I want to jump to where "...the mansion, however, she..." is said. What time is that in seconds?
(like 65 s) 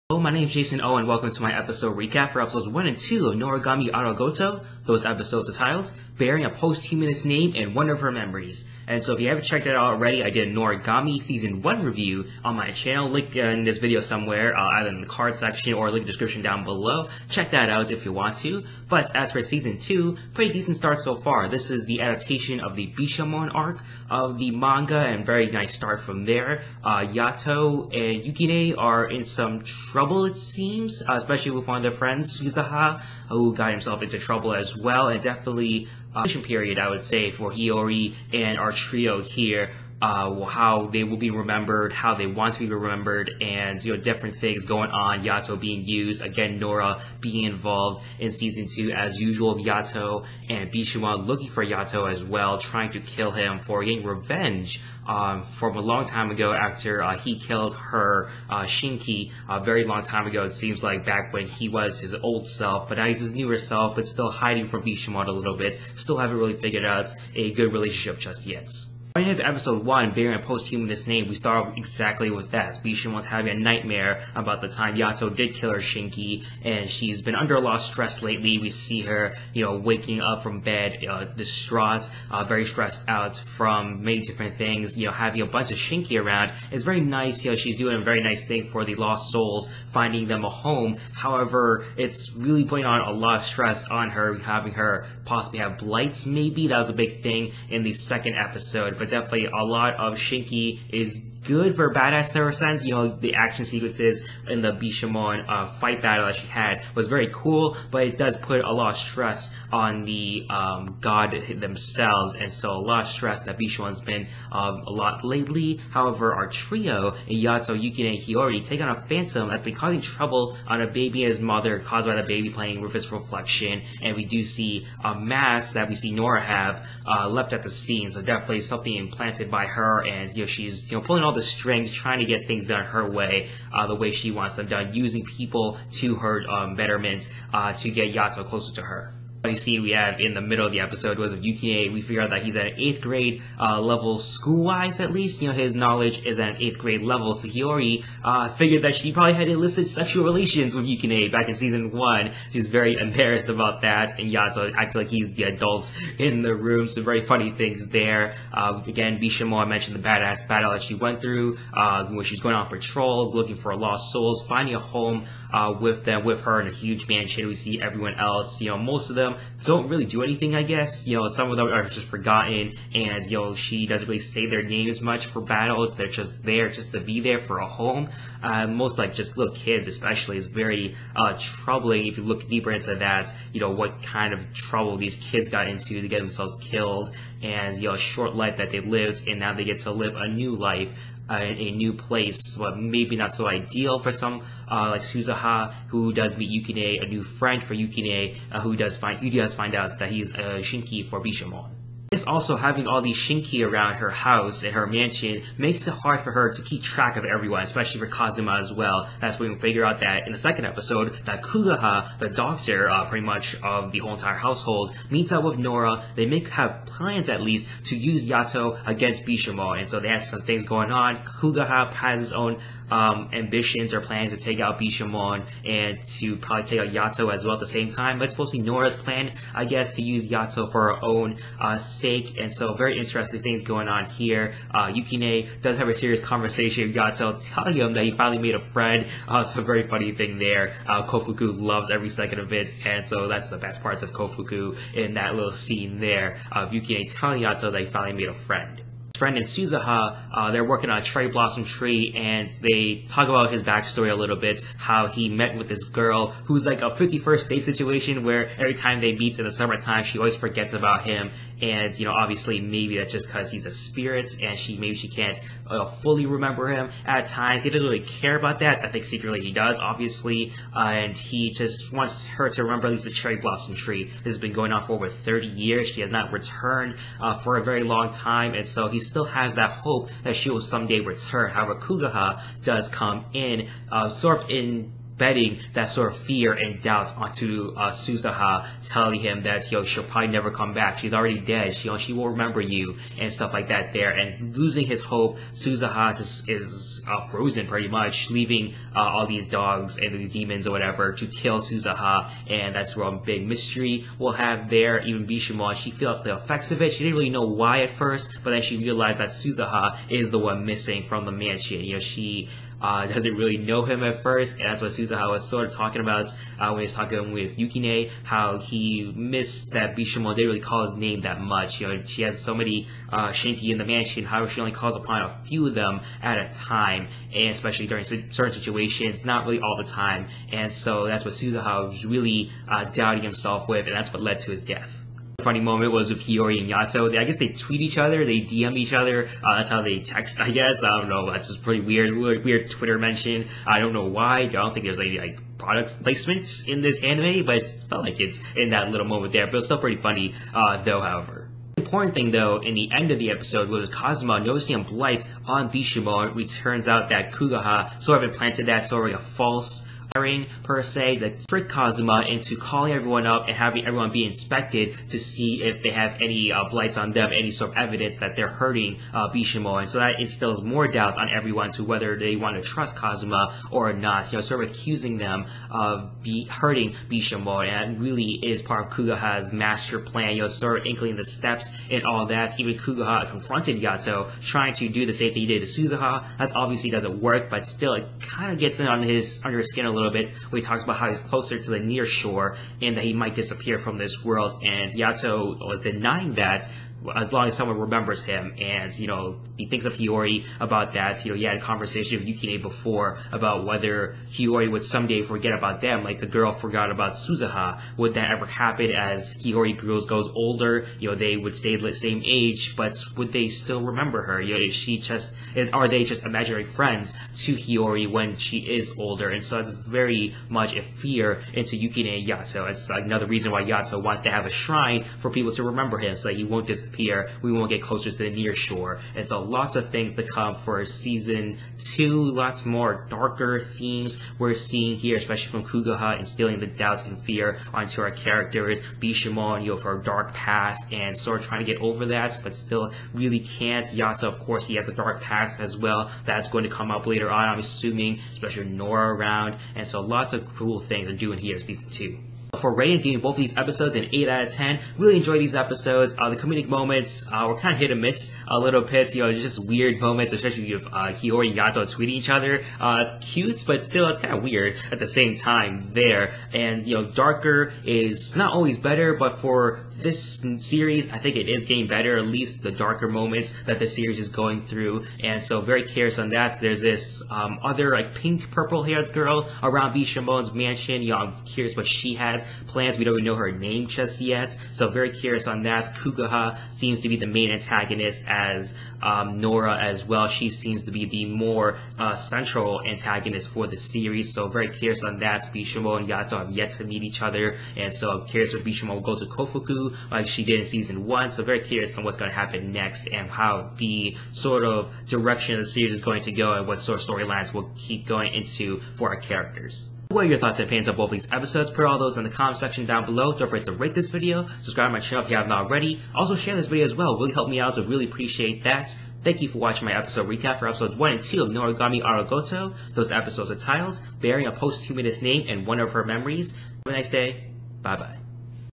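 323 s.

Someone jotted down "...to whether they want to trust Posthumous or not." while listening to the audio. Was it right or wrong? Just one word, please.
wrong.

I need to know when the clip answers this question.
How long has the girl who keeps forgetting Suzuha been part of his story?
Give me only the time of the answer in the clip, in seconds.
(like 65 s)
274 s.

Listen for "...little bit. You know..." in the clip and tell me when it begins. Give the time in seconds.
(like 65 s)
458 s.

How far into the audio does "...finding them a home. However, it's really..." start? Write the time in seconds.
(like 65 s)
89 s.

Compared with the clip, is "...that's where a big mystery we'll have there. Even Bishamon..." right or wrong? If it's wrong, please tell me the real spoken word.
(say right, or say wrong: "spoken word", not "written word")
right.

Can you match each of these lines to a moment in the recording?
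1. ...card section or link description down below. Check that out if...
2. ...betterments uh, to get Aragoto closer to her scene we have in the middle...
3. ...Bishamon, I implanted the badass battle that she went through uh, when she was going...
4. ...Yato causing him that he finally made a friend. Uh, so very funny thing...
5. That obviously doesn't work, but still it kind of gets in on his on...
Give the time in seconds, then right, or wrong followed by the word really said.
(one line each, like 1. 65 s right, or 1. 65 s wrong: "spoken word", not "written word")
1. 15 s right
2. 136 s wrong: "Yato", not "Aragoto"
3. 159 s wrong: "mentioned", not "implanted"
4. 236 s wrong: "telling", not "causing"
5. 386 s right.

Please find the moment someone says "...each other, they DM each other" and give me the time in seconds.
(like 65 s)
337 s.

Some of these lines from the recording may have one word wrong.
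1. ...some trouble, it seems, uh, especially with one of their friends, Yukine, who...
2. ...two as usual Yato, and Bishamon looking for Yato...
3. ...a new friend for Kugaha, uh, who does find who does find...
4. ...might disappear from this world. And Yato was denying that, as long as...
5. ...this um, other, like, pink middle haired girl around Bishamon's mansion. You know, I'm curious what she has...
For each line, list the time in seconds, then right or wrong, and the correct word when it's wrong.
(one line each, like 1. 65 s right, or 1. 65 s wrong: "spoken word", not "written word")
1. 29 s wrong: "Suzuha", not "Yukine"
2. 48 s right
3. 197 s wrong: "Yukine", not "Kugaha"
4. 393 s right
5. 476 s wrong: "purple", not "middle".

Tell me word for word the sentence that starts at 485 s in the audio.
Kugaha seems to be the main antagonist as um, Nora as well.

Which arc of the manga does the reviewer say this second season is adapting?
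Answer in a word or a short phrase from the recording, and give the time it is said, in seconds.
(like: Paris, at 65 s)
the Bishamon arc, at 22 s.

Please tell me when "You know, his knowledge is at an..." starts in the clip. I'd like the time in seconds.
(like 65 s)
145 s.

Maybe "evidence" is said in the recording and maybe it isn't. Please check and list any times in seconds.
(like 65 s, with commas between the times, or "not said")
367 s.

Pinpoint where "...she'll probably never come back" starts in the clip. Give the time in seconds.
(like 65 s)
289 s.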